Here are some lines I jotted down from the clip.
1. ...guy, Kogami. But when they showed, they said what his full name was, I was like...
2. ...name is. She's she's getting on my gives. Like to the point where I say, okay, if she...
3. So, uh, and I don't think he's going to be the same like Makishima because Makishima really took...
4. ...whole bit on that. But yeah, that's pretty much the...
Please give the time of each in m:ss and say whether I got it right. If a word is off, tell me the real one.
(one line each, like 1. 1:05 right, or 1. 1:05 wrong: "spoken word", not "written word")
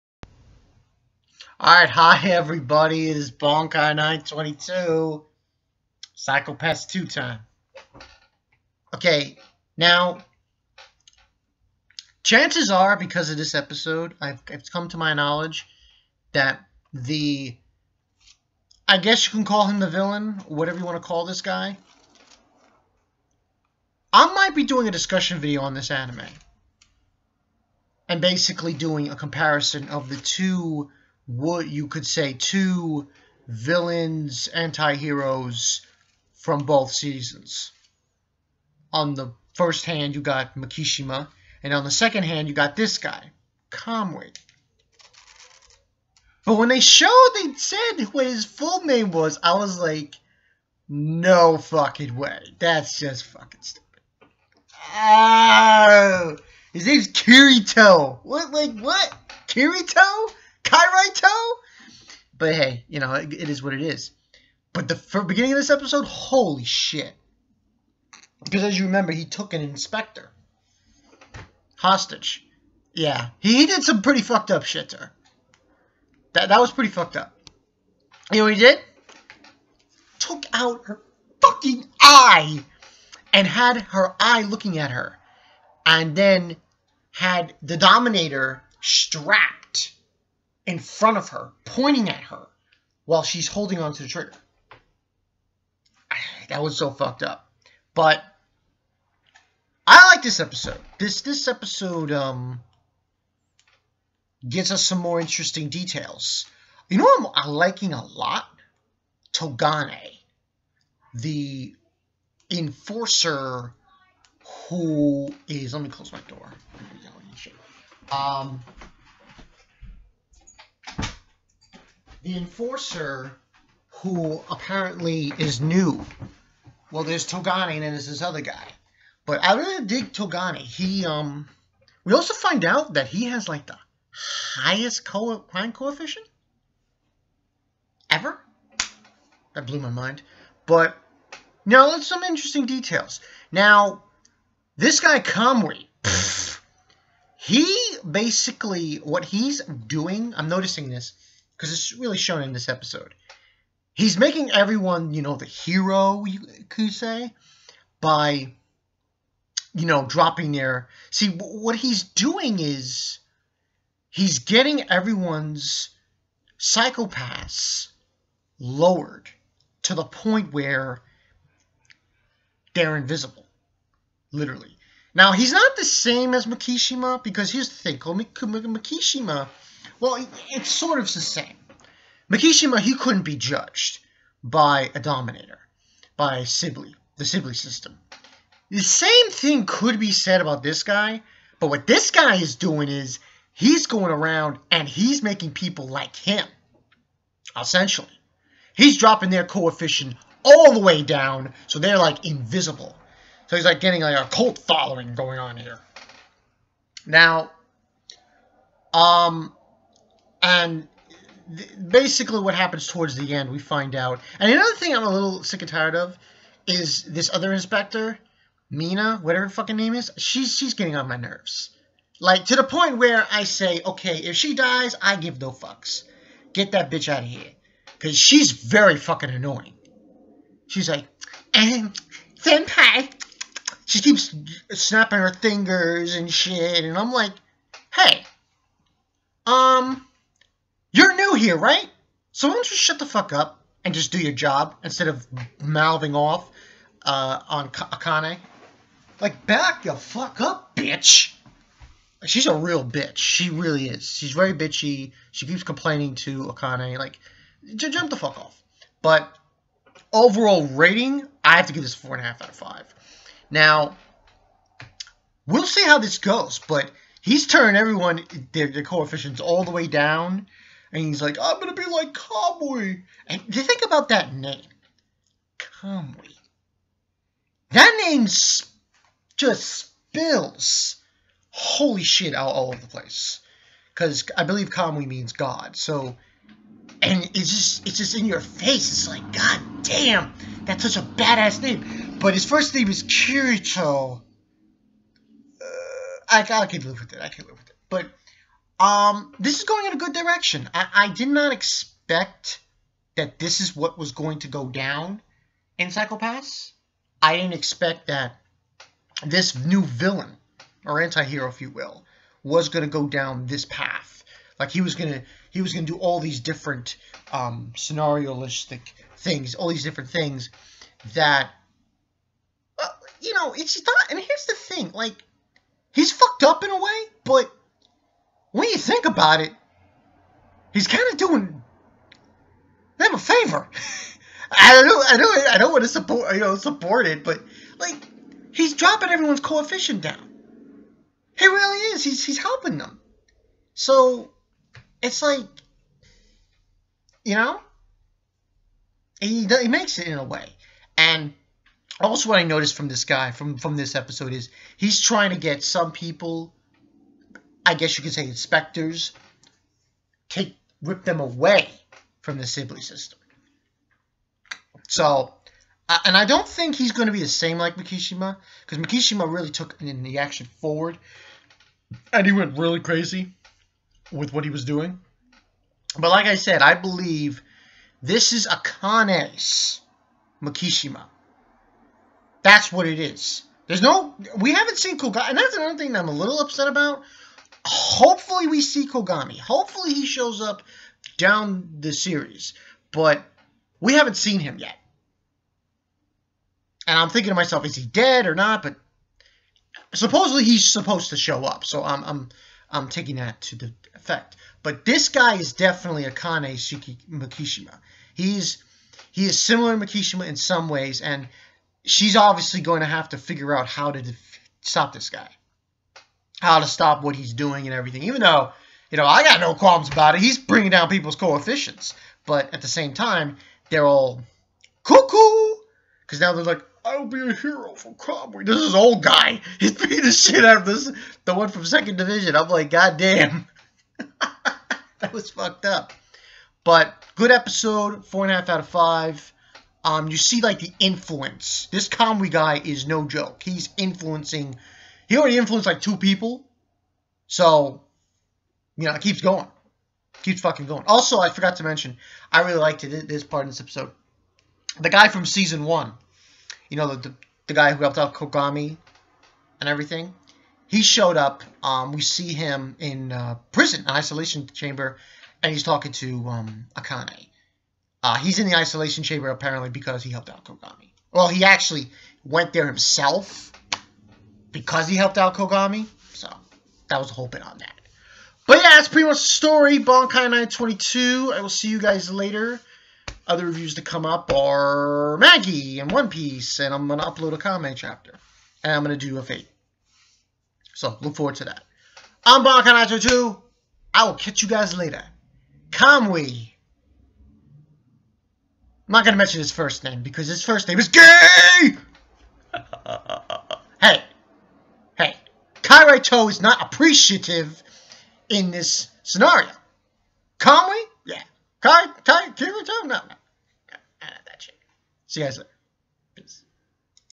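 1. 0:42 wrong: "Kamui", not "Kogami"
2. 3:39 wrong: "nerves", not "gives"
3. 6:04 right
4. 7:57 right.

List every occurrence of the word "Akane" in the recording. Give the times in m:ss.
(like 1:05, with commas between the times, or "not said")
4:07, 4:16, 6:18, 7:46.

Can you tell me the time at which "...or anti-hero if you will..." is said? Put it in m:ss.
5:10.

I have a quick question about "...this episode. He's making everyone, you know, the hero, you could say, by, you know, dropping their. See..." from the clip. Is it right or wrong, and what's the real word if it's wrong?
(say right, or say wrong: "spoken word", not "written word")
right.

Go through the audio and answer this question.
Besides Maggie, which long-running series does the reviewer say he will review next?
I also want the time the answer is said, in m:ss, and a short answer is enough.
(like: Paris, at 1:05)
One Piece, at 8:05.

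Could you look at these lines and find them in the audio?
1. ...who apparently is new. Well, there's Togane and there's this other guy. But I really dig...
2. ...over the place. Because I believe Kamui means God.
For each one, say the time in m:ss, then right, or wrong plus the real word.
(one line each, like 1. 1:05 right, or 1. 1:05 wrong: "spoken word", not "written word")
1. 2:03 right
2. 4:42 right.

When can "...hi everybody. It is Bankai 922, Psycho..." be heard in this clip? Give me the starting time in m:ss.
0:01.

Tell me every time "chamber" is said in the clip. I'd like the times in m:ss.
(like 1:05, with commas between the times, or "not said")
7:44, 7:49.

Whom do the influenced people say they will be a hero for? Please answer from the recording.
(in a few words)
Cromwell.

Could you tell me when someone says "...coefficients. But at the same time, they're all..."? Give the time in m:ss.
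7:01.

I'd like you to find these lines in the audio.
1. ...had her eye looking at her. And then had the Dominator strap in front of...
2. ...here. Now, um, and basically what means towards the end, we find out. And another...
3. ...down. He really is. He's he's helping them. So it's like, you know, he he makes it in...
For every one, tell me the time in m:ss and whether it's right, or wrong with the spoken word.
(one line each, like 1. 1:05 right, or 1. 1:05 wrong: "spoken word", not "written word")
1. 1:23 right
2. 3:25 wrong: "happens", not "means"
3. 5:40 right.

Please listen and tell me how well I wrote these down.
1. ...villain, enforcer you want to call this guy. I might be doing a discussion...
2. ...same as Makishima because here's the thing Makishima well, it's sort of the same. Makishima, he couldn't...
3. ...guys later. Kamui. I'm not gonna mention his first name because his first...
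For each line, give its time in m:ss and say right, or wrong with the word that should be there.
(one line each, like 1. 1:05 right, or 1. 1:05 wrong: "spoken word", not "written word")
1. 0:19 wrong: "whatever", not "enforcer"
2. 2:55 right
3. 8:14 right.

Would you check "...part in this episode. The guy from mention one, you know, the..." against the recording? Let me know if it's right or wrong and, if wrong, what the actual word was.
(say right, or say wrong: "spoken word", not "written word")
wrong: "season", not "mention".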